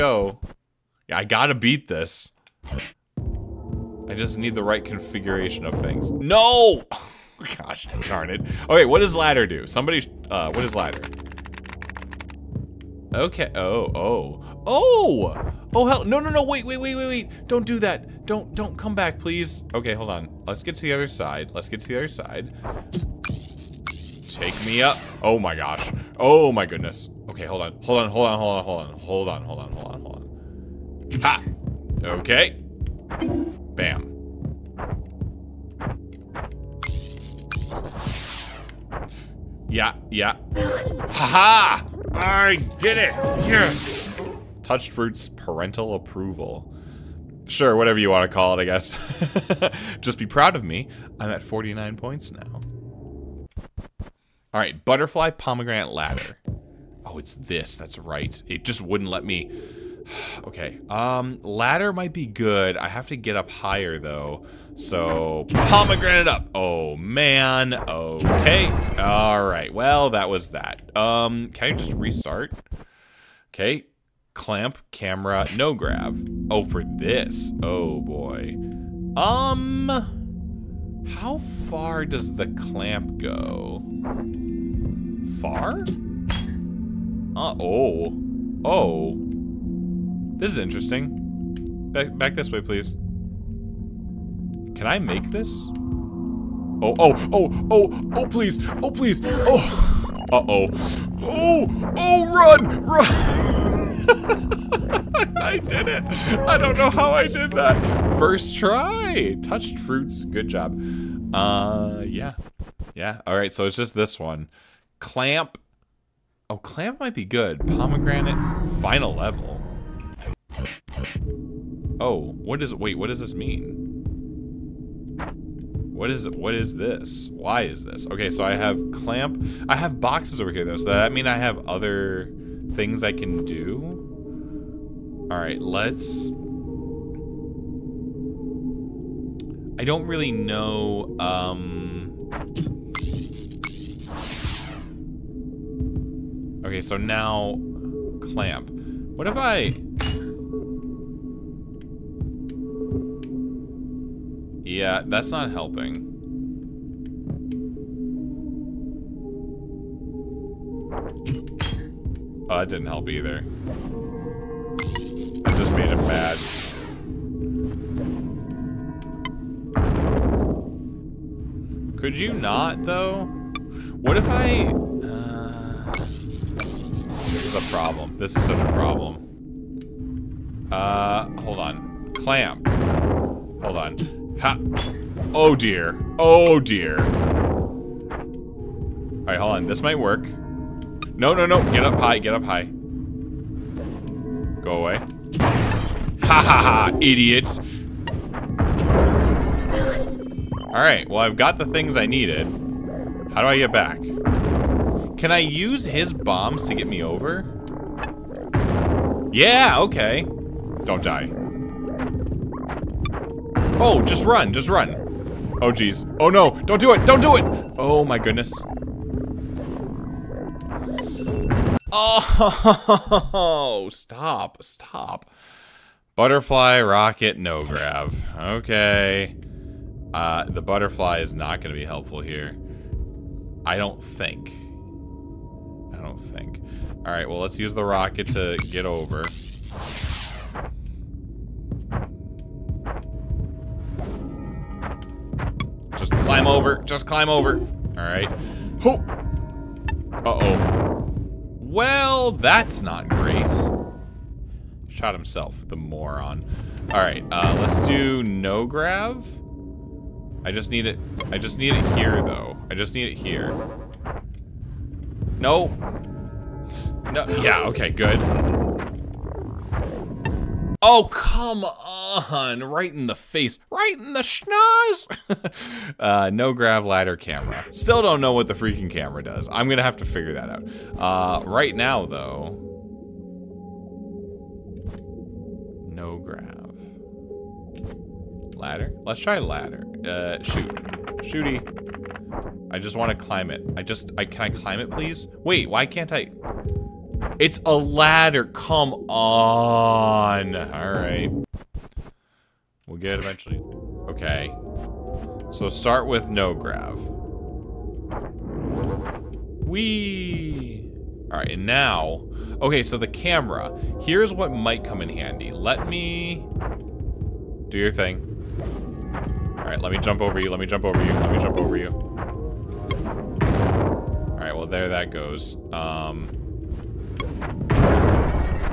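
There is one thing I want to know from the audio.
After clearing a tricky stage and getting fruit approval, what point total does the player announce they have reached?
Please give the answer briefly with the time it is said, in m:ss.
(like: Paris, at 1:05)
49 points, at 0:51.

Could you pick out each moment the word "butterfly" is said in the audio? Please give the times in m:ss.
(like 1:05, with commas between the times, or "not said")
0:54, 3:46, 3:50.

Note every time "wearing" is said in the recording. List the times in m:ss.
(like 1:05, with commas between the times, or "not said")
not said.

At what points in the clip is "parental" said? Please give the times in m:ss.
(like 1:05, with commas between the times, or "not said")
0:45.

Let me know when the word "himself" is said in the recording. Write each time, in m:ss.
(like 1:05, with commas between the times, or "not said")
4:15.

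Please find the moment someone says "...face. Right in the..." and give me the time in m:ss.
4:33.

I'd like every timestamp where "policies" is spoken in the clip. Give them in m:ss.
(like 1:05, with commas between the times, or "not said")
not said.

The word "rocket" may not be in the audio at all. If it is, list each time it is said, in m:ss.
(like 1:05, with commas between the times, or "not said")
3:46, 3:57.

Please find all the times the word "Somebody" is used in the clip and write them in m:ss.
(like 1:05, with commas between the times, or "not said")
0:09.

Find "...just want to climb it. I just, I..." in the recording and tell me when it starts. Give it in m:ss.
4:52.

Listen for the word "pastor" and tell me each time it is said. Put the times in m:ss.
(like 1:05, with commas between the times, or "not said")
not said.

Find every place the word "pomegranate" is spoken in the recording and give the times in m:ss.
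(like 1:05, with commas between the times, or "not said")
0:55, 1:05, 1:57.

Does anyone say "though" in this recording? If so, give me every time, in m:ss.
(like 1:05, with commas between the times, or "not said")
1:03, 2:10, 2:52, 4:22, 4:42.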